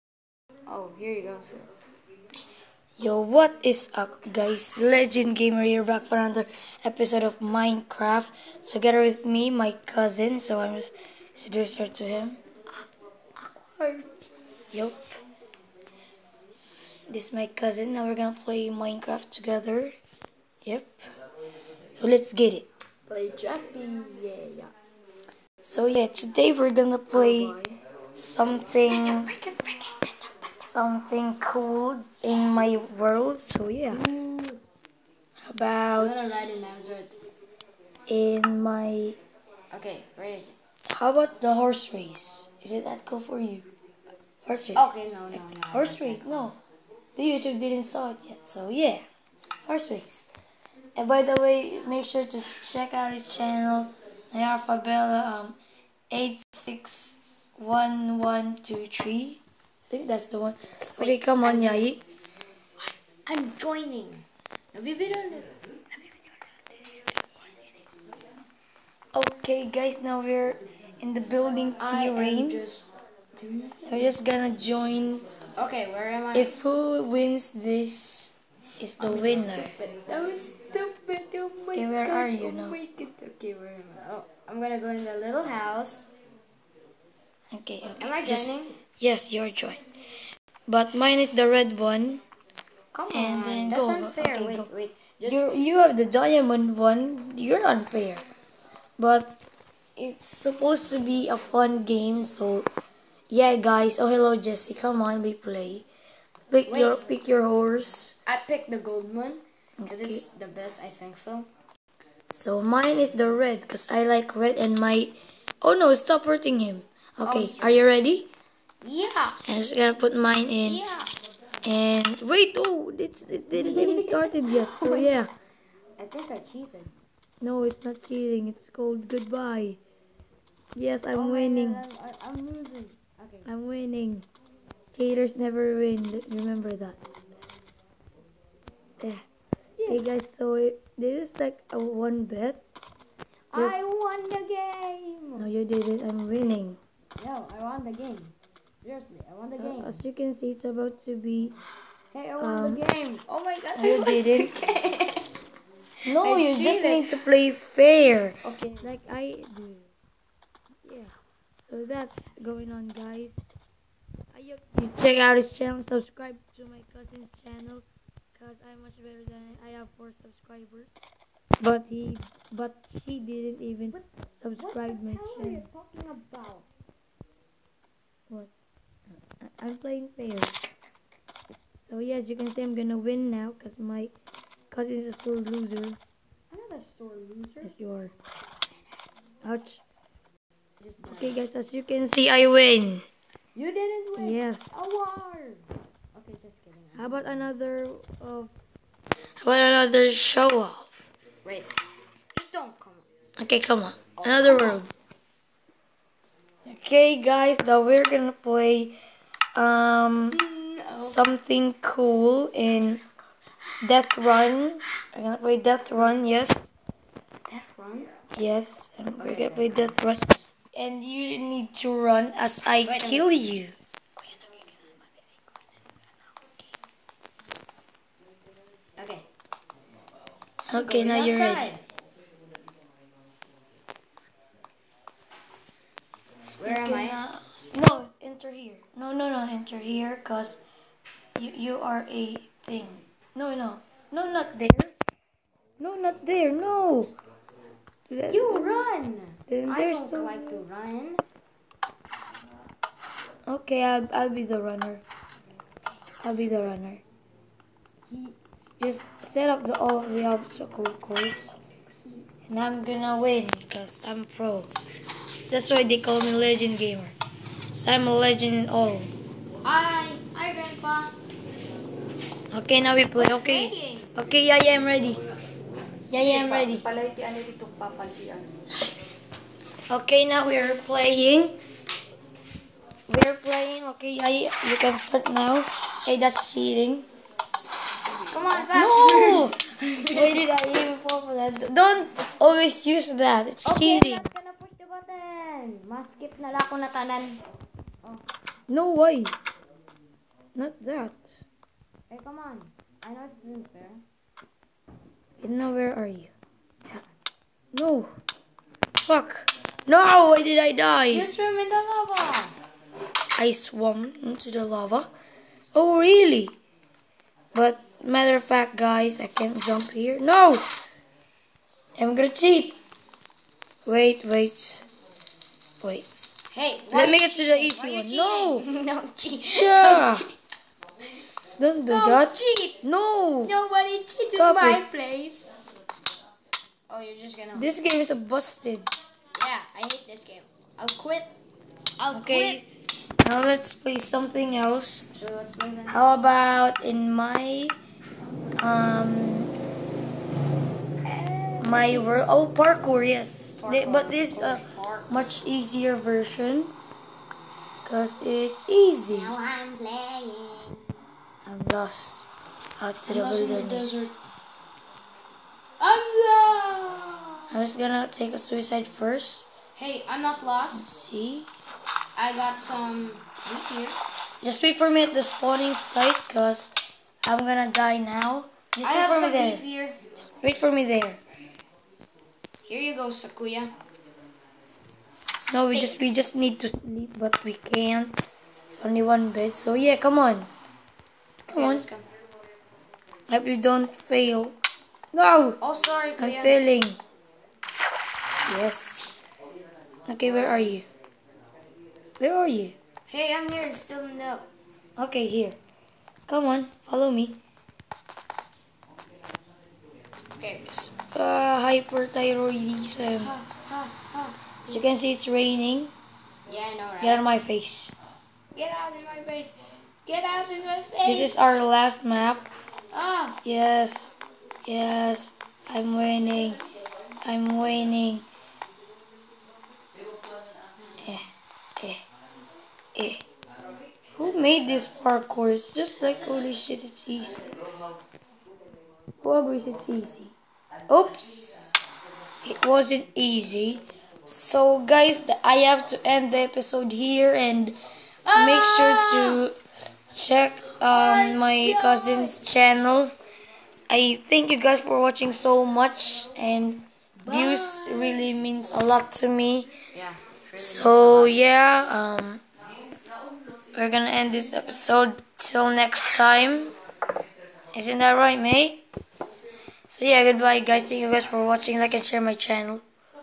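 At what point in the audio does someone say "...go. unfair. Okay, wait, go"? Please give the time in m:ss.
1:33.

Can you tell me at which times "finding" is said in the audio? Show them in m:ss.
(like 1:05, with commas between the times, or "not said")
not said.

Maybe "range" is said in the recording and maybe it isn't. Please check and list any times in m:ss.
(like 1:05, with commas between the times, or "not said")
not said.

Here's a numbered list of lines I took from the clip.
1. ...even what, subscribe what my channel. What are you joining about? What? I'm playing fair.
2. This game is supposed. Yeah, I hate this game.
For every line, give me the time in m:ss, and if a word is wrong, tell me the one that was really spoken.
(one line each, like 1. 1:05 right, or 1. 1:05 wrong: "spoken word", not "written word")
1. 2:53 wrong: "talking", not "joining"
2. 5:37 wrong: "busted", not "supposed".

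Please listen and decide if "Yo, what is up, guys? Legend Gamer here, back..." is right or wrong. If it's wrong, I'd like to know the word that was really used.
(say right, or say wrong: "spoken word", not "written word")
right.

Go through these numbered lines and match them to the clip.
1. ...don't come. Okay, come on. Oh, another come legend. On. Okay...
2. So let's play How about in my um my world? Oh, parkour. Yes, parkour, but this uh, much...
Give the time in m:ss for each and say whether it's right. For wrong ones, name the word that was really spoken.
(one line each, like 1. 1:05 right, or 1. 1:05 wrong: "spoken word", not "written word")
1. 3:22 wrong: "round", not "legend"
2. 5:45 right.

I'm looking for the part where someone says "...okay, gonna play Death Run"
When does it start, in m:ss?
3:39.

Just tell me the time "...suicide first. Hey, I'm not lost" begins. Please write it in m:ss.
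6:08.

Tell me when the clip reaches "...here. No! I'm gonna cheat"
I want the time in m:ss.
5:19.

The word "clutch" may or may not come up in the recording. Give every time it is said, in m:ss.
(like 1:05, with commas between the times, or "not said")
not said.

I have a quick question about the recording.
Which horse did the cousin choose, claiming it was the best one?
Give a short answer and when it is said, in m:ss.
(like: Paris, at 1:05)
The gold one, at 1:48.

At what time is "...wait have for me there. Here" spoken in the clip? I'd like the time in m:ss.
6:18.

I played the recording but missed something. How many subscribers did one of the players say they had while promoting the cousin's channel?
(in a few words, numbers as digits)
4.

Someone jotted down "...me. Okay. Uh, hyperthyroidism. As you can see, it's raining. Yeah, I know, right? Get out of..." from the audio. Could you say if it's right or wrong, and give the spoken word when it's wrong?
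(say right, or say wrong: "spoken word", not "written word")
right.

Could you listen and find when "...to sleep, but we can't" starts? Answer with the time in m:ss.
6:26.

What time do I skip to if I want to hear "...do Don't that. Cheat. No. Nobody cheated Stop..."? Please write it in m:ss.
5:31.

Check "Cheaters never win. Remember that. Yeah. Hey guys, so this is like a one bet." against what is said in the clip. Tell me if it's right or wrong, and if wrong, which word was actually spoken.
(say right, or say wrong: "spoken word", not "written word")
right.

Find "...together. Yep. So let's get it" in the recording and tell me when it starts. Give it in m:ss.
0:19.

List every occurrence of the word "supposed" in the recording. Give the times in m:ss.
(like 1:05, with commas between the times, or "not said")
1:40.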